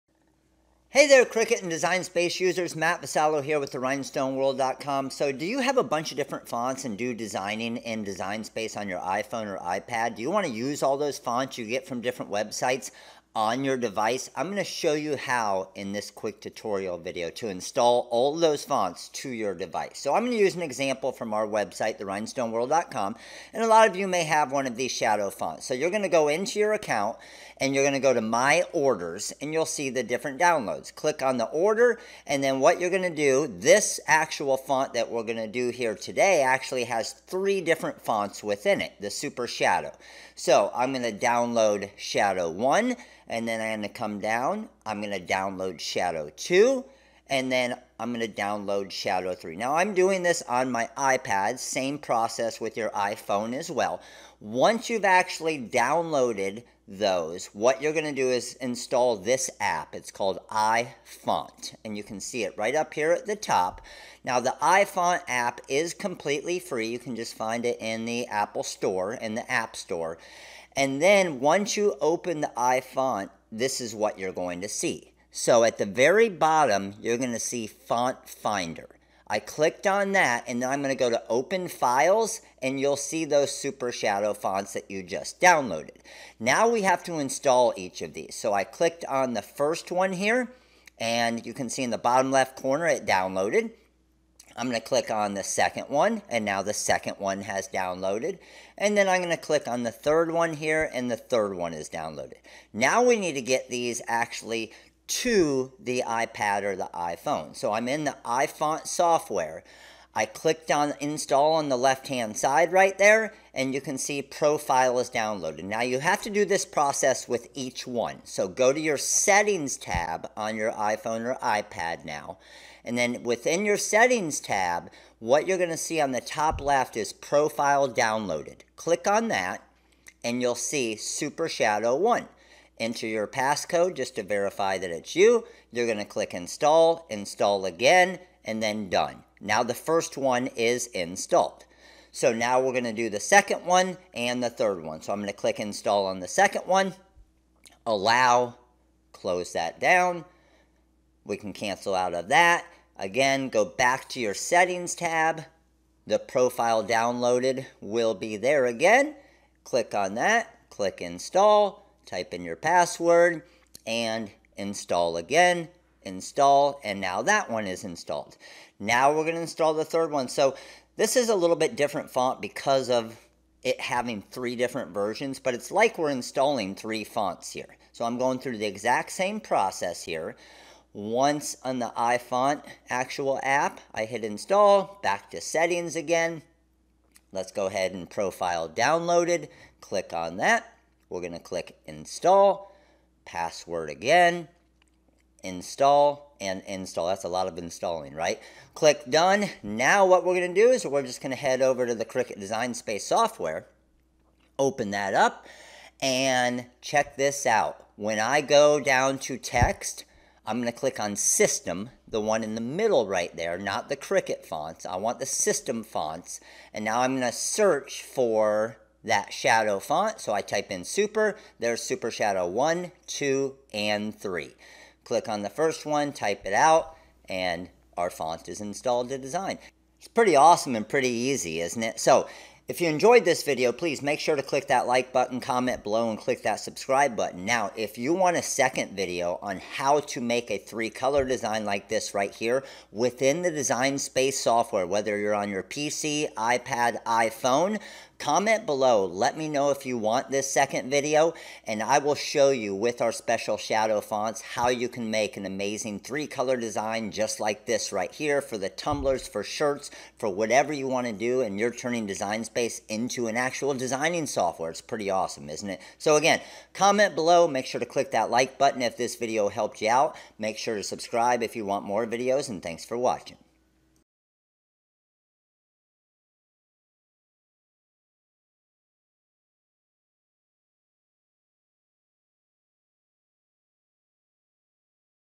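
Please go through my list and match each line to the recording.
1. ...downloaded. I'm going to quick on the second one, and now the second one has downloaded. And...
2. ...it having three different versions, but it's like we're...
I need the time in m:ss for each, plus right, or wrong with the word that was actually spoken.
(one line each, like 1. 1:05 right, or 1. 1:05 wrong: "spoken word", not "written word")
1. 1:33 wrong: "click", not "quick"
2. 2:53 right.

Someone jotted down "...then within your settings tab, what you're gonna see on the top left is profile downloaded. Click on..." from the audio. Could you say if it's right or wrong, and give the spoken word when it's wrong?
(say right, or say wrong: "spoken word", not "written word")
right.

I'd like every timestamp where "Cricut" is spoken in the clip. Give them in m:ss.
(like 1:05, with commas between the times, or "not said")
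0:01, 3:22, 3:33.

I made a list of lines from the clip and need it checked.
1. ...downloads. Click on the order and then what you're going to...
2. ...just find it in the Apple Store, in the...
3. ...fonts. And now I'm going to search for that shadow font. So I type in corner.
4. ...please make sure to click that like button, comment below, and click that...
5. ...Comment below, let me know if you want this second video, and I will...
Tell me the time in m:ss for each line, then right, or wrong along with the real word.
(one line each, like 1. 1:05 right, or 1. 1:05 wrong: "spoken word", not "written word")
1. 0:30 right
2. 1:07 right
3. 3:35 wrong: "super", not "corner"
4. 3:53 right
5. 4:08 right.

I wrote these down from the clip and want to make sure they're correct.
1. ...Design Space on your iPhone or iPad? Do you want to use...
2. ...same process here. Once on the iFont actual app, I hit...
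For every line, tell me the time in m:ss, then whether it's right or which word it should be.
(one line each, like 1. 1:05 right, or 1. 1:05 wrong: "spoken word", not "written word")
1. 0:08 right
2. 2:59 right.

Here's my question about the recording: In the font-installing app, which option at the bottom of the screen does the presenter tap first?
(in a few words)
Font Finder.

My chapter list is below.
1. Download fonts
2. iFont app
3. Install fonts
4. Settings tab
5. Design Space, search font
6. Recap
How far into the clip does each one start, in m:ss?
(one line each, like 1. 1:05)
1. 0:20
2. 0:58
3. 1:11
4. 1:47
5. 3:22
6. 3:50.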